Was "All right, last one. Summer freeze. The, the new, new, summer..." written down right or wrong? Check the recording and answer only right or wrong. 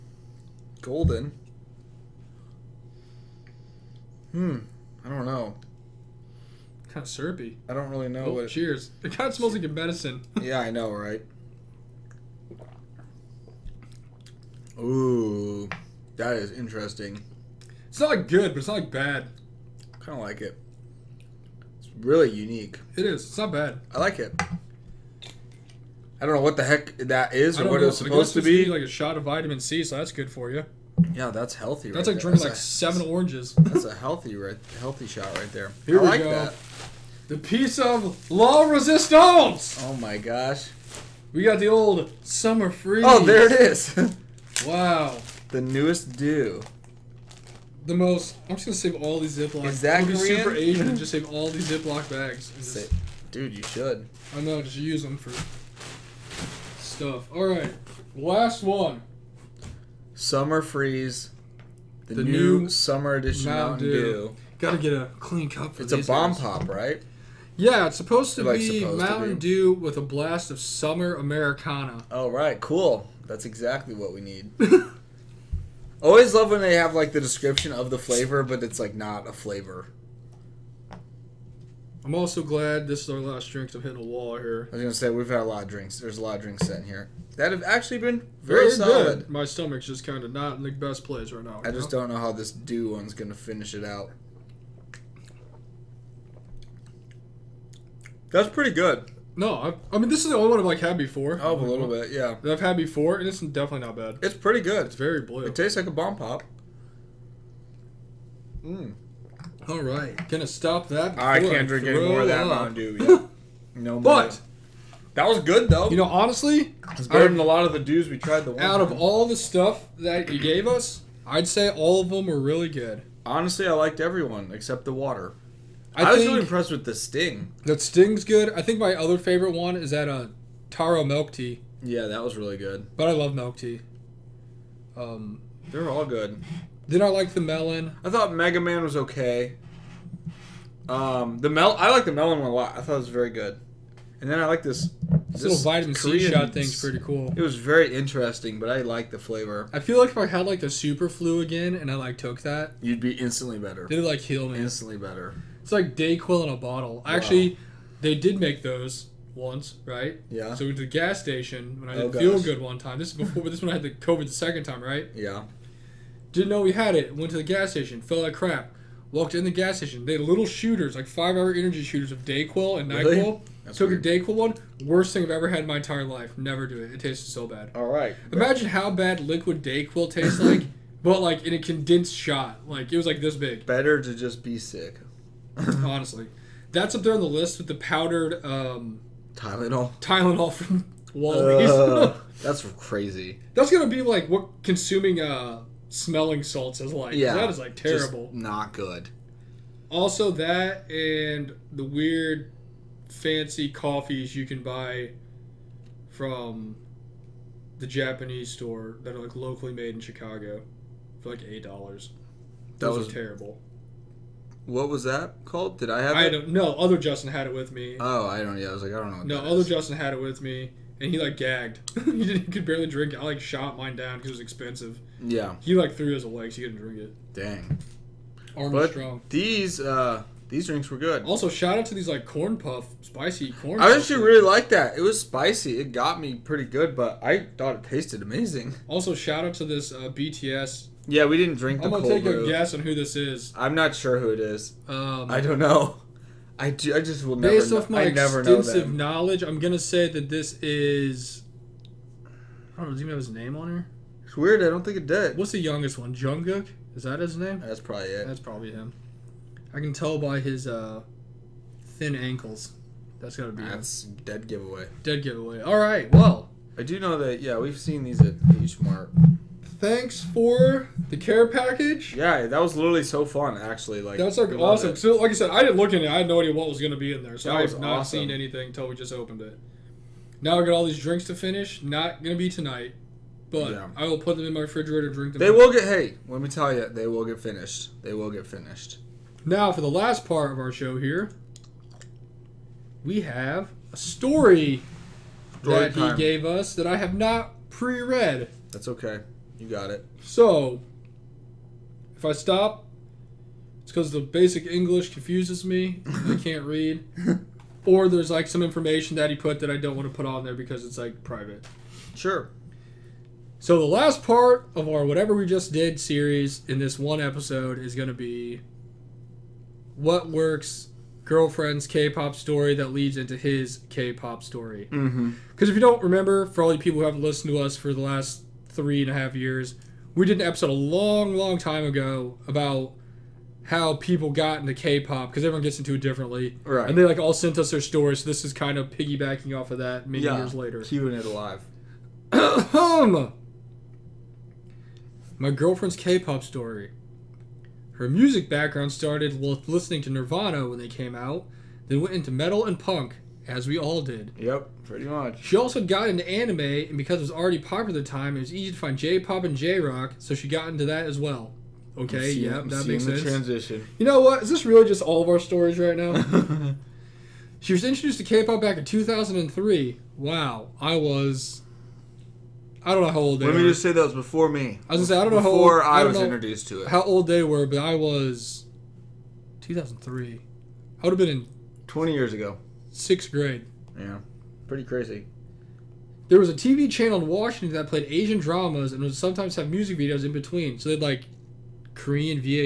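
right.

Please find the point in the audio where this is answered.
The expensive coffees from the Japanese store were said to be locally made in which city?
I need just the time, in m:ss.
3:30.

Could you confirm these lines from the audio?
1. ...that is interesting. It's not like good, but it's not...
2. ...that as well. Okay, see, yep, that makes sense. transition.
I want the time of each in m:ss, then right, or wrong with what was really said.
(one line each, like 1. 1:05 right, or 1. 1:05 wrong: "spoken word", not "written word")
1. 0:16 right
2. 6:00 right.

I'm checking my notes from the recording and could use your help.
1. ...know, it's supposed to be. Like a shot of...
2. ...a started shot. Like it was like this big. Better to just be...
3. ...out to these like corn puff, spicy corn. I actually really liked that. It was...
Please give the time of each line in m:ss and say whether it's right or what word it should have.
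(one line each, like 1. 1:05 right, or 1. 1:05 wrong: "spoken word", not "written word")
1. 0:27 right
2. 3:01 wrong: "condensed", not "started"
3. 3:51 right.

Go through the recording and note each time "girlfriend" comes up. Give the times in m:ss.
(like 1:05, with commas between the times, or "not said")
5:21, 5:45.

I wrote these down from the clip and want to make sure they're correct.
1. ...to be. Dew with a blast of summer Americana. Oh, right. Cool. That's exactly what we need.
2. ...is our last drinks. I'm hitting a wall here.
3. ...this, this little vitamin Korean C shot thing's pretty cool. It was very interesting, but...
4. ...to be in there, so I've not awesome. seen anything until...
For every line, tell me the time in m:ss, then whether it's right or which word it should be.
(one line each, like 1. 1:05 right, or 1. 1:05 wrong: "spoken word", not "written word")
1. 1:09 right
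2. 1:23 right
3. 2:25 right
4. 4:36 right.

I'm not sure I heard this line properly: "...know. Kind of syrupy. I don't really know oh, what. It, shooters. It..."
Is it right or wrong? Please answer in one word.
wrong.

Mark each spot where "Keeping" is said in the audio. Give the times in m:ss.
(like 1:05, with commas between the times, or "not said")
5:40.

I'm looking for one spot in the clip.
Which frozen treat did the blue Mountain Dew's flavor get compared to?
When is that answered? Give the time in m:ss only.
1:45.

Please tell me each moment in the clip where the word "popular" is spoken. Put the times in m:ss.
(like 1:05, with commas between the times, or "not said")
5:57.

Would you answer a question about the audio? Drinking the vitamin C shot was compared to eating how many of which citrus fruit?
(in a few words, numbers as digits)
7 oranges.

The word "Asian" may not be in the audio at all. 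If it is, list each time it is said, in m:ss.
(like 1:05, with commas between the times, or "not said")
0:50, 6:28.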